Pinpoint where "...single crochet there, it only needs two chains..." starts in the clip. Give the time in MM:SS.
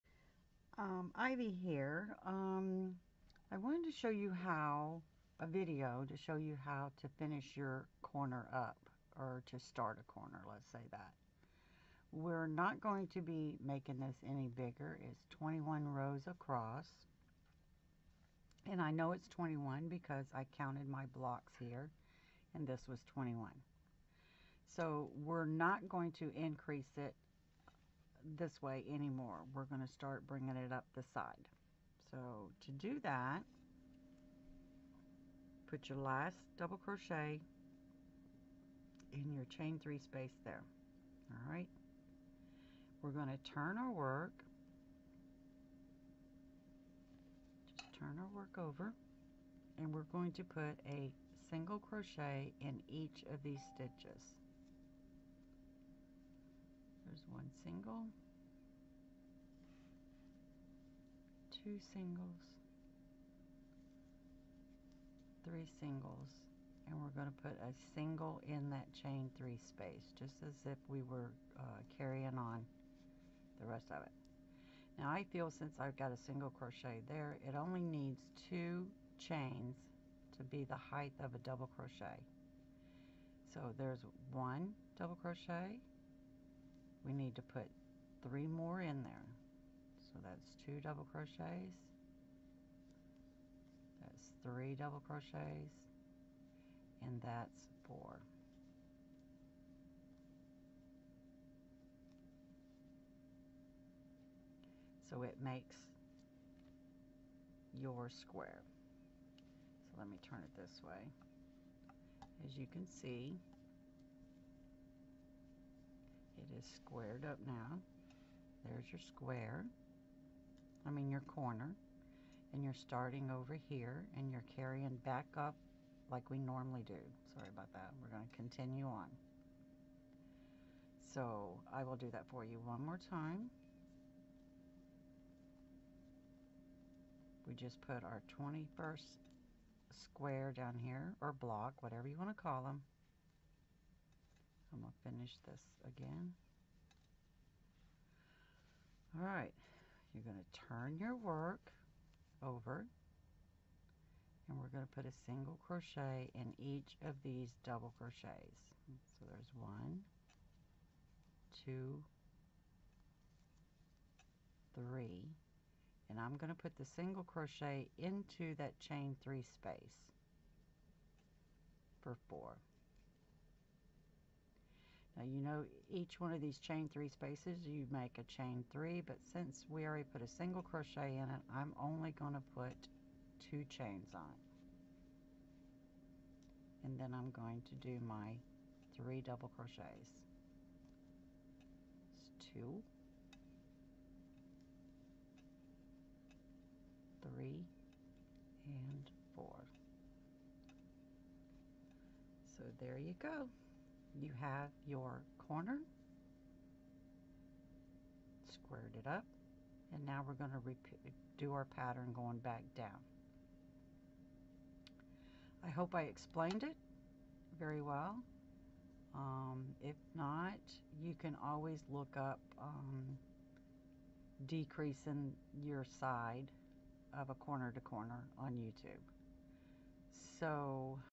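01:16.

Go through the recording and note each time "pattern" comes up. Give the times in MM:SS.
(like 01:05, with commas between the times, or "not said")
03:31.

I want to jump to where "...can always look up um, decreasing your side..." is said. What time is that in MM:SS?
03:41.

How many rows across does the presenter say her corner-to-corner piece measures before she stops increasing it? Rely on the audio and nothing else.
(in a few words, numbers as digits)
21.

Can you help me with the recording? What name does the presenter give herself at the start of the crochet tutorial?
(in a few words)
Ivy.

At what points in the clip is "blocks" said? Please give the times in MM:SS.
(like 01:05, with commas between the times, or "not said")
00:21, 02:21.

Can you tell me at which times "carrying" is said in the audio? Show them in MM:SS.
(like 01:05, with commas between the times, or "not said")
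01:11, 02:04.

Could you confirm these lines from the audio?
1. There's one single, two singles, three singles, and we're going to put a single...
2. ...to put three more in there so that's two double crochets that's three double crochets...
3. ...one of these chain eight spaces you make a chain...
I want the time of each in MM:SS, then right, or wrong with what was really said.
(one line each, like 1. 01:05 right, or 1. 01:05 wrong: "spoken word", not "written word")
1. 00:57 right
2. 01:27 right
3. 02:56 wrong: "three", not "eight".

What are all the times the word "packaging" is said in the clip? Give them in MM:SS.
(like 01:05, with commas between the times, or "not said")
not said.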